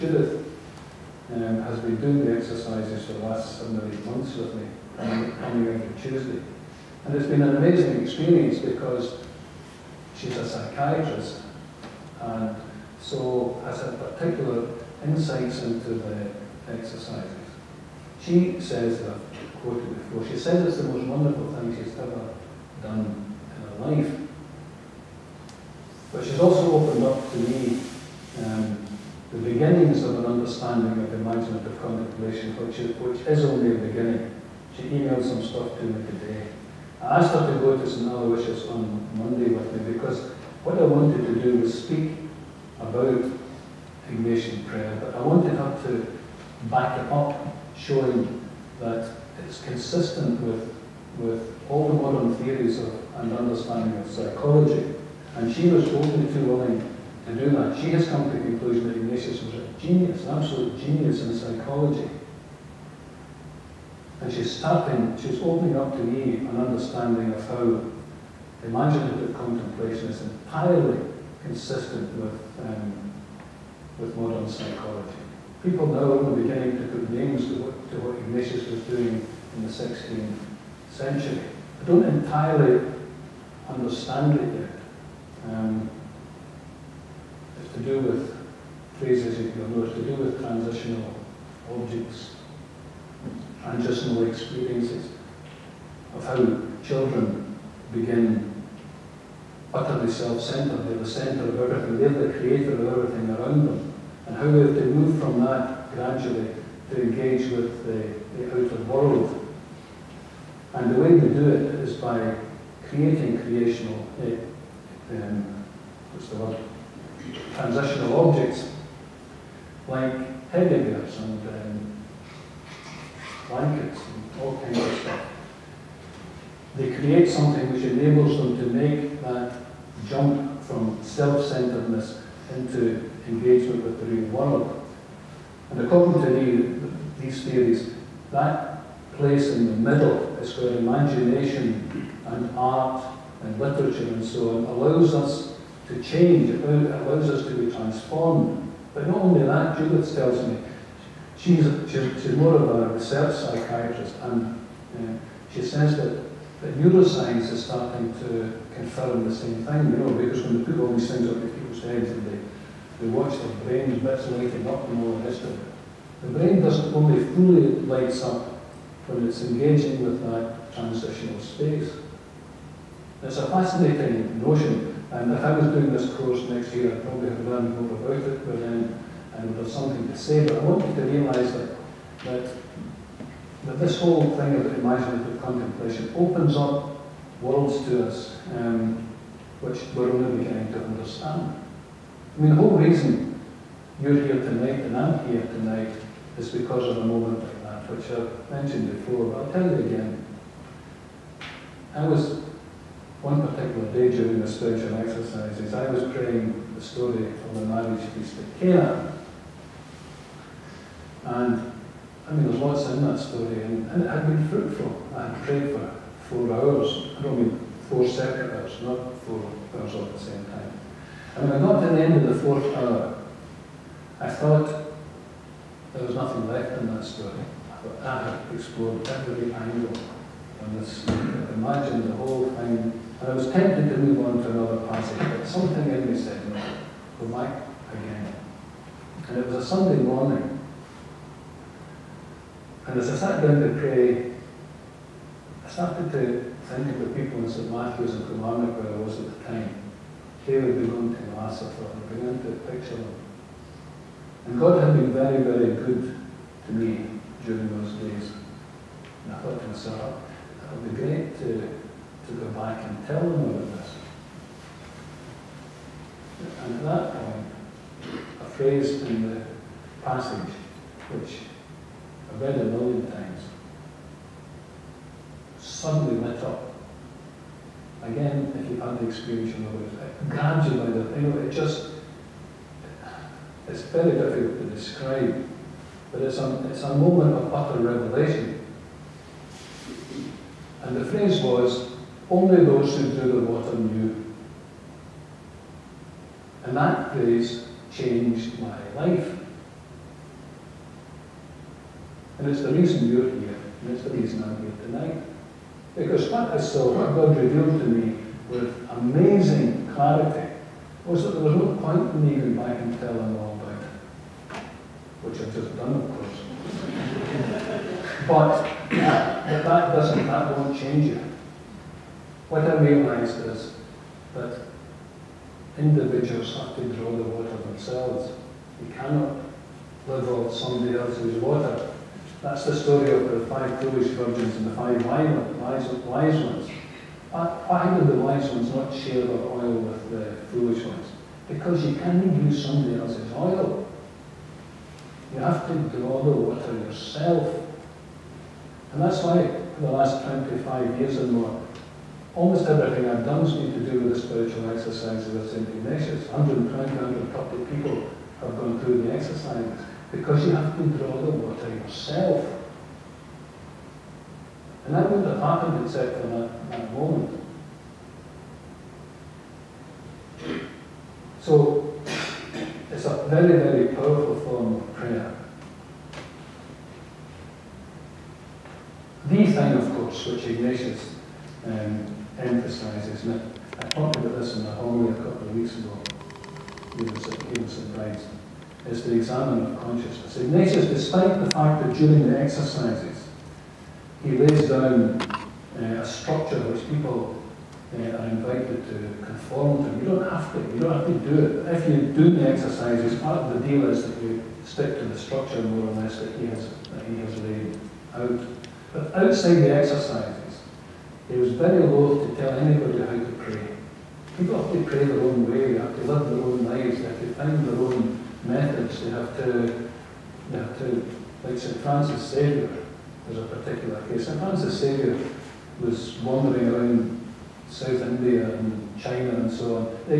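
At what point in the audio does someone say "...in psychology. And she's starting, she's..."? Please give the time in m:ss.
1:01.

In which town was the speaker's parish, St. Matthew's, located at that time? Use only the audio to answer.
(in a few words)
Kilmarnock.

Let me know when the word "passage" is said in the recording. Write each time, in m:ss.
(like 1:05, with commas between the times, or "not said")
3:54, 4:30.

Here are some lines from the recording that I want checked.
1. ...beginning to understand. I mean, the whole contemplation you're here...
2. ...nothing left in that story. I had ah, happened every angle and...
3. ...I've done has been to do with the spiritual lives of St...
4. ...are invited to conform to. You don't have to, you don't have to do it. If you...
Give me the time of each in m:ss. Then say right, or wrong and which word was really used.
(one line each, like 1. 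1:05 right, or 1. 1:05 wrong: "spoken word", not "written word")
1. 3:10 wrong: "reason", not "contemplation"
2. 3:46 wrong: "explored", not "happened"
3. 5:53 wrong: "exercises", not "lives"
4. 6:38 right.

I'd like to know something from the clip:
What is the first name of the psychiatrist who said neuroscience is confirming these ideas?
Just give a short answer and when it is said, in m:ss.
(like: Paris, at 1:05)
Judith, at 2:29.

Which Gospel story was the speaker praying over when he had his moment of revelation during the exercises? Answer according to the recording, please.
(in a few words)
Marriage feast at Cana.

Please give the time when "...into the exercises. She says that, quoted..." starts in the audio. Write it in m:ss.
0:15.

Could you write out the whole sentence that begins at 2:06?
They create something which enables them to make that jump from self-centeredness into engagement with the real world.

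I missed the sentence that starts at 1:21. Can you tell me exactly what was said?
I don't entirely understand it yet.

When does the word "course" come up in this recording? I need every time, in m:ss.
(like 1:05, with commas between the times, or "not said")
2:56, 5:16, 6:19.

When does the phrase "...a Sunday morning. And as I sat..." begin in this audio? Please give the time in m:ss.
3:59.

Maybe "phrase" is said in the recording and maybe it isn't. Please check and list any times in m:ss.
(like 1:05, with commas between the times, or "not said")
1:28, 4:28, 4:51, 4:57.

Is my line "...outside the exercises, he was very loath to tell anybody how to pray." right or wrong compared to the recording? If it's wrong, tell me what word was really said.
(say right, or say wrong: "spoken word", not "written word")
right.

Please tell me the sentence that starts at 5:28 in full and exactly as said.
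You cannot live off somebody else's water.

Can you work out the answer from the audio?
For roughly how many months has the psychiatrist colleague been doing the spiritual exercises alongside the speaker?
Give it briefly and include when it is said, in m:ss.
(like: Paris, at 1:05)
7 or 8 months, at 0:03.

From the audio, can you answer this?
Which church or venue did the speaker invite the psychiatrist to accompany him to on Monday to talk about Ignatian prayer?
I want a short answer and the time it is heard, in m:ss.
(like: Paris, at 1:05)
St. Aloysius, at 0:37.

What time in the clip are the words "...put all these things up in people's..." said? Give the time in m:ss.
2:40.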